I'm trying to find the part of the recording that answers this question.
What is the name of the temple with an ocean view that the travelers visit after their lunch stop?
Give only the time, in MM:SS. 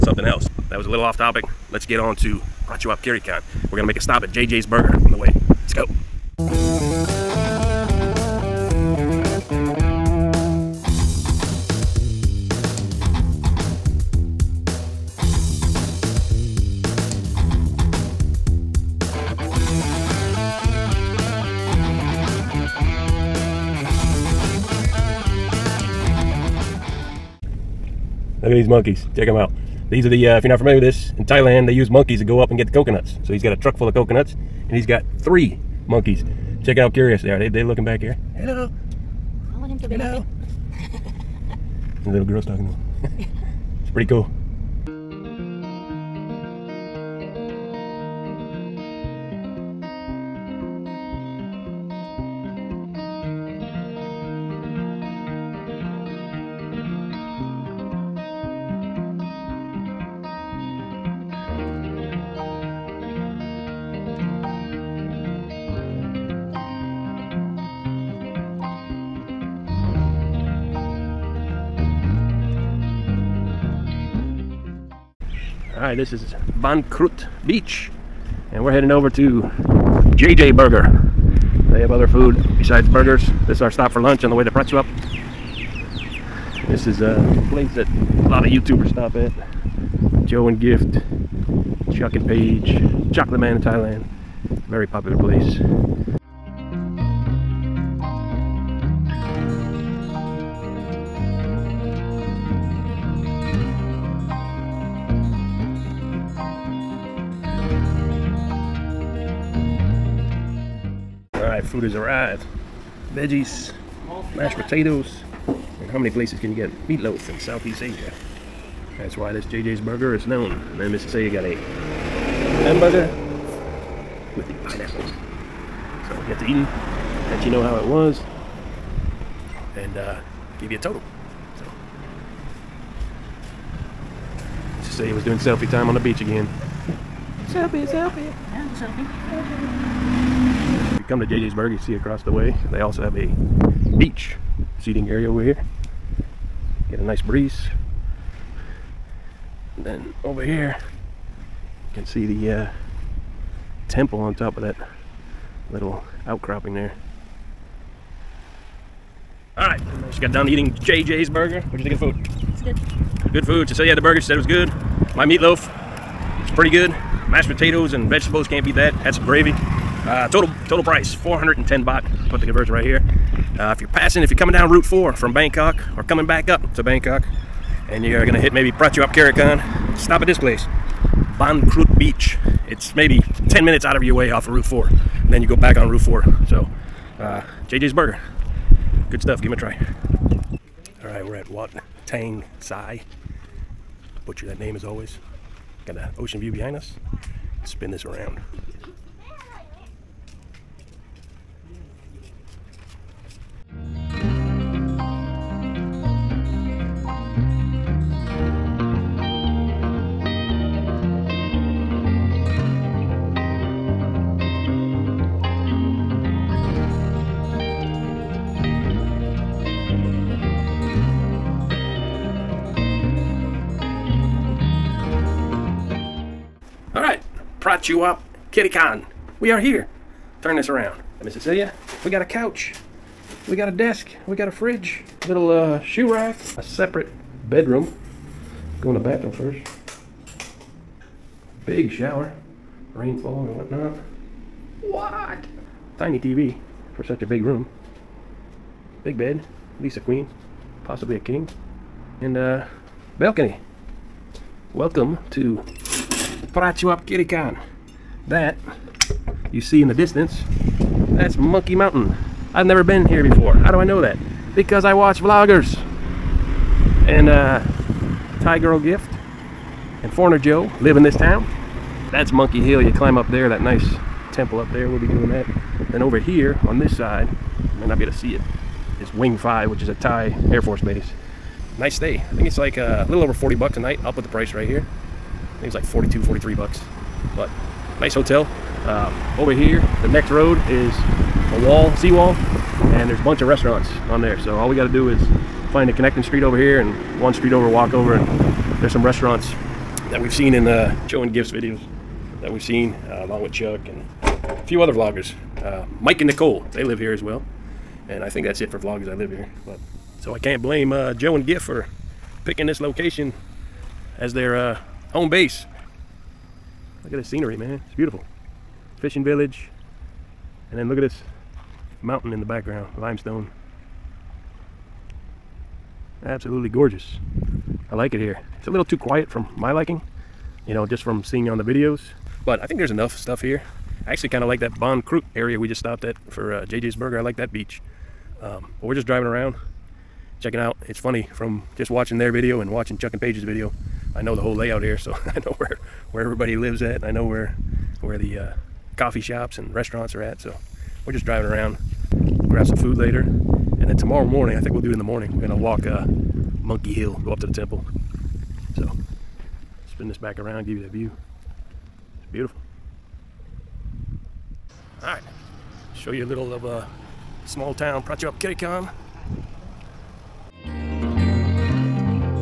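03:11.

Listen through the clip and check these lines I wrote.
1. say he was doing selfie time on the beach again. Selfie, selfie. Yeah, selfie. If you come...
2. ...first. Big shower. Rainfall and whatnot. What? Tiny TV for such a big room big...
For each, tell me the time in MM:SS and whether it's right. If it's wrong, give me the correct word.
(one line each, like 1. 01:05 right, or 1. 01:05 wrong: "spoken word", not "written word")
1. 02:14 right
2. 03:59 right.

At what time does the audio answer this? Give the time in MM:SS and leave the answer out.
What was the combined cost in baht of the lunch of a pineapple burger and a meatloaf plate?
02:51.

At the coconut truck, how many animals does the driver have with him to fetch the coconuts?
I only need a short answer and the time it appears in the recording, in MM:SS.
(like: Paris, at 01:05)
3, at 00:35.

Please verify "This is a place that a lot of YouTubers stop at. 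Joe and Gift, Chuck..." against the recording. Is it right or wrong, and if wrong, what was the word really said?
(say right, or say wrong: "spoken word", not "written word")
right.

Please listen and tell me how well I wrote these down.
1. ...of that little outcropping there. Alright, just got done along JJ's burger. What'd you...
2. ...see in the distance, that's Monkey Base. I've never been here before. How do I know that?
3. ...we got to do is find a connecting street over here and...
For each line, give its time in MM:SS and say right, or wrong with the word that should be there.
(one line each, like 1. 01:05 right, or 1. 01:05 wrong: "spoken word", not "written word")
1. 02:34 wrong: "eating", not "along"
2. 04:19 wrong: "Mountain", not "Base"
3. 04:54 right.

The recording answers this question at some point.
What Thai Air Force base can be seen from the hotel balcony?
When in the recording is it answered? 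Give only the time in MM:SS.
04:39.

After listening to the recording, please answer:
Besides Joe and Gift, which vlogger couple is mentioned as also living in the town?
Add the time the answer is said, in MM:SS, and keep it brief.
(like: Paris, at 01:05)
Mike and Nicole, at 05:05.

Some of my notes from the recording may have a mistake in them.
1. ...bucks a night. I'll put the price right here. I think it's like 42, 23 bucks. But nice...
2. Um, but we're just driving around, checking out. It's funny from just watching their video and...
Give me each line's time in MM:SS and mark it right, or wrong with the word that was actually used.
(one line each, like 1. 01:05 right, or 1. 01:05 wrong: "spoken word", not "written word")
1. 04:43 wrong: "43", not "23"
2. 05:38 right.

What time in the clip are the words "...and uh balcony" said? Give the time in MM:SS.
04:12.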